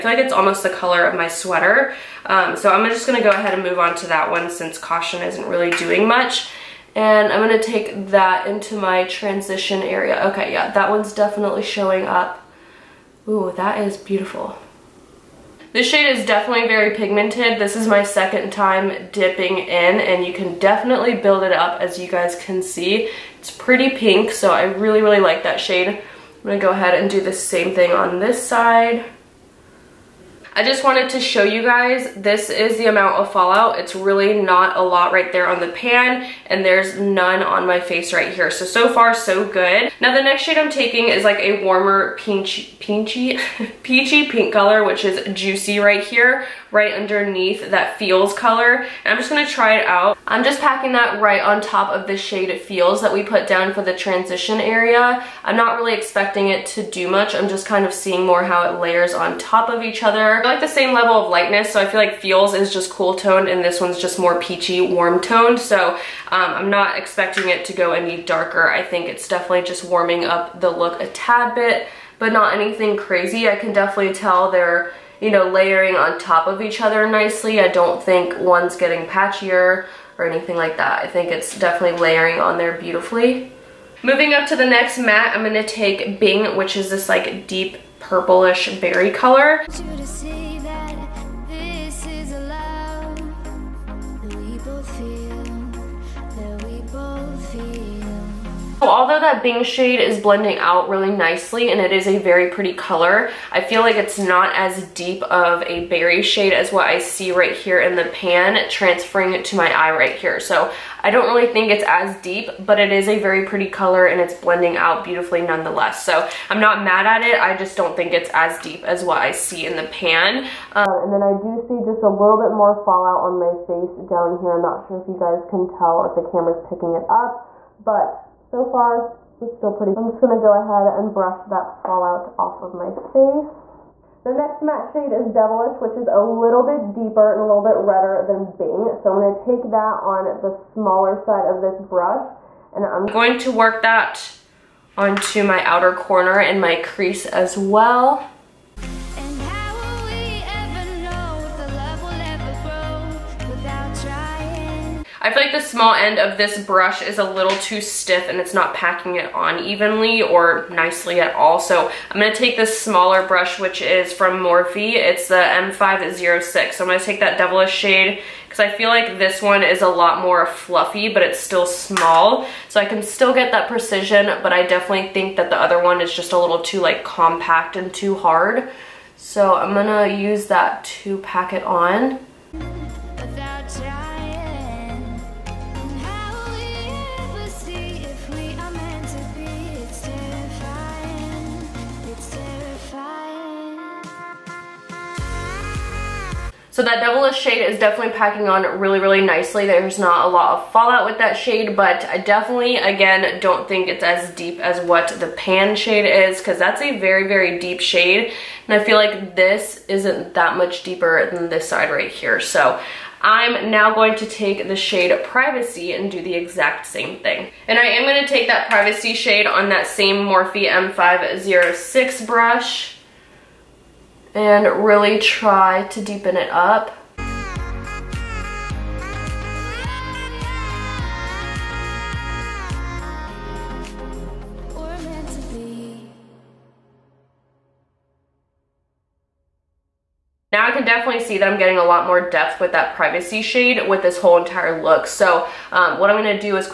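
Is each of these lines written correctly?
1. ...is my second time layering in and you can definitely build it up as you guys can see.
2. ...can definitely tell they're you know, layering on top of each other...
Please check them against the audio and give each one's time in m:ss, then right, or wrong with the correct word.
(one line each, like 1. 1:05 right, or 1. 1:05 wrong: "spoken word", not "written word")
1. 0:17 wrong: "dipping", not "layering"
2. 1:13 right.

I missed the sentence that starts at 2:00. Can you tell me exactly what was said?
Um, and then I do see just a little bit more fallout on my face down here.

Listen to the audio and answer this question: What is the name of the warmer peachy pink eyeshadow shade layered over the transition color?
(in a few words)
Juicy.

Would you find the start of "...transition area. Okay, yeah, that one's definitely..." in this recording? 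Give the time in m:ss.
0:09.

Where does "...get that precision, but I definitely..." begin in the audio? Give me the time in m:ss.
2:53.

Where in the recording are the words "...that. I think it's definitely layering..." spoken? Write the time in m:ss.
1:20.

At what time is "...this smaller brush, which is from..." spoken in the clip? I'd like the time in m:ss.
2:42.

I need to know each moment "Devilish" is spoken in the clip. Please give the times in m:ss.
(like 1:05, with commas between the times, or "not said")
2:15, 2:47, 3:16.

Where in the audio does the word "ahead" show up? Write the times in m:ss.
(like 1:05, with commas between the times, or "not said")
0:03, 0:26, 2:10.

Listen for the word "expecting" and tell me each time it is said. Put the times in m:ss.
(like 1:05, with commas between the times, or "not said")
0:55, 1:06.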